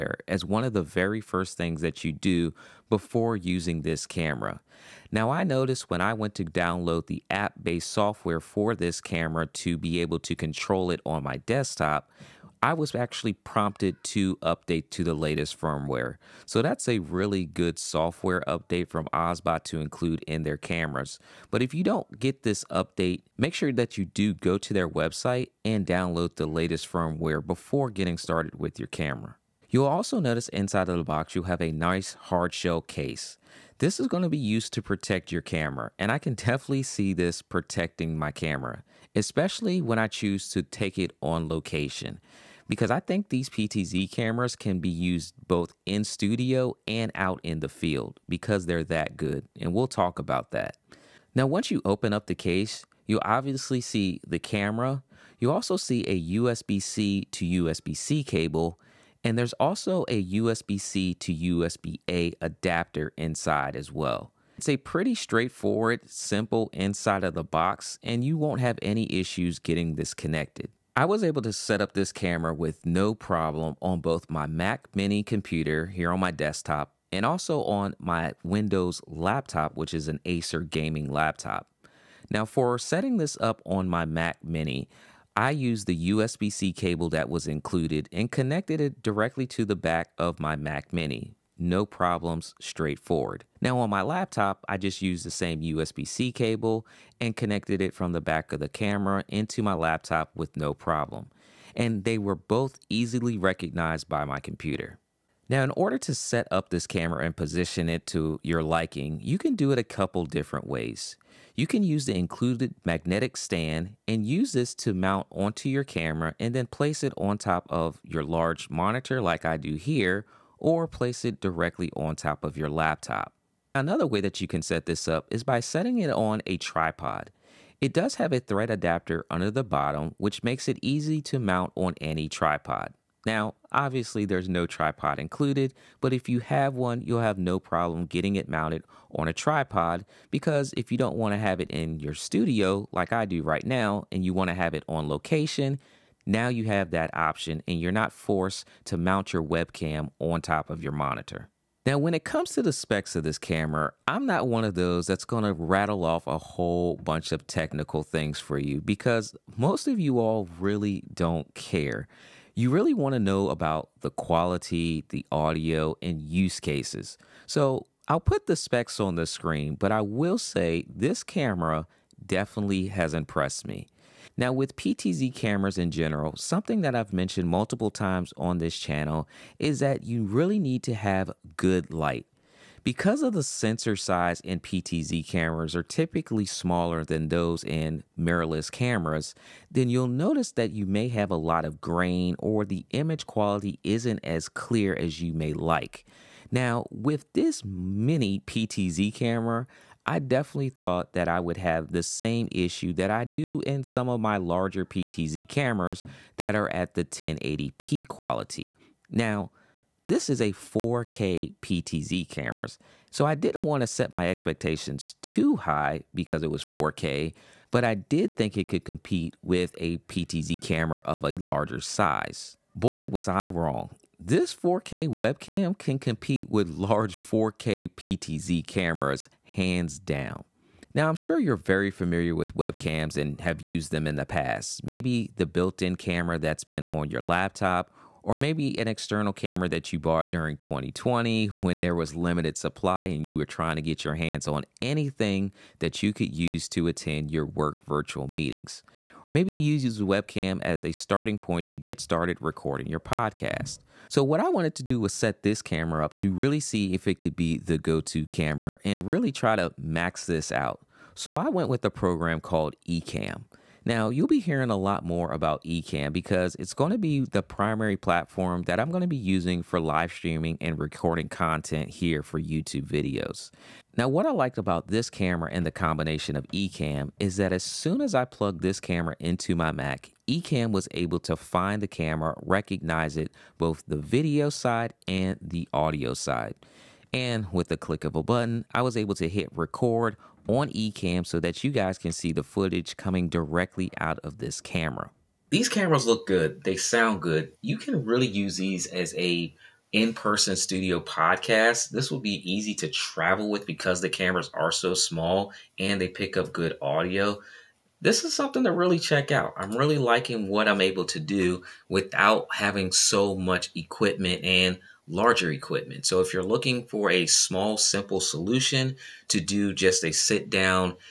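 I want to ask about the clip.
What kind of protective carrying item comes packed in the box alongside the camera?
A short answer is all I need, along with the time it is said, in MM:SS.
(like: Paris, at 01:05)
hard shell case, at 00:32.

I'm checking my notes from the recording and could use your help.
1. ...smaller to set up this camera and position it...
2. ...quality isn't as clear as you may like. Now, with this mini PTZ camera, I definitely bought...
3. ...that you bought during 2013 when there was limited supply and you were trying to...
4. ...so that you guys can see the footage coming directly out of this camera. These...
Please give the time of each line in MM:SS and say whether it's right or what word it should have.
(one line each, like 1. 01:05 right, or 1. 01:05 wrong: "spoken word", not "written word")
1. 01:45 wrong: "order", not "smaller"
2. 03:13 wrong: "thought", not "bought"
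3. 03:59 wrong: "2020", not "2013"
4. 04:51 right.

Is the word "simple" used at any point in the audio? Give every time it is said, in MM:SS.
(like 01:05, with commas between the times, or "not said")
01:06, 05:17.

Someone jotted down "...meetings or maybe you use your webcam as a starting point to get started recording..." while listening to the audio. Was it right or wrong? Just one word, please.
right.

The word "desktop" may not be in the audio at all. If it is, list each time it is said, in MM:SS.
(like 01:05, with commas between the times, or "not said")
00:11, 01:16.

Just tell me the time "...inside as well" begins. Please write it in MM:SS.
01:03.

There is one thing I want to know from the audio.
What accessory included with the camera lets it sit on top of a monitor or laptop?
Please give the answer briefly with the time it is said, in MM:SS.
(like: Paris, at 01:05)
magnetic stand, at 01:52.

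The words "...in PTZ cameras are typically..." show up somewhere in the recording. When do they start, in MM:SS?
03:04.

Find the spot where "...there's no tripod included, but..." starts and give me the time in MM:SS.
02:14.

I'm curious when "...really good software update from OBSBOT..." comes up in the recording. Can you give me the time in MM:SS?
00:16.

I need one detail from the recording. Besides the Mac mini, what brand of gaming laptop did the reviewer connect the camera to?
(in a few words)
Acer.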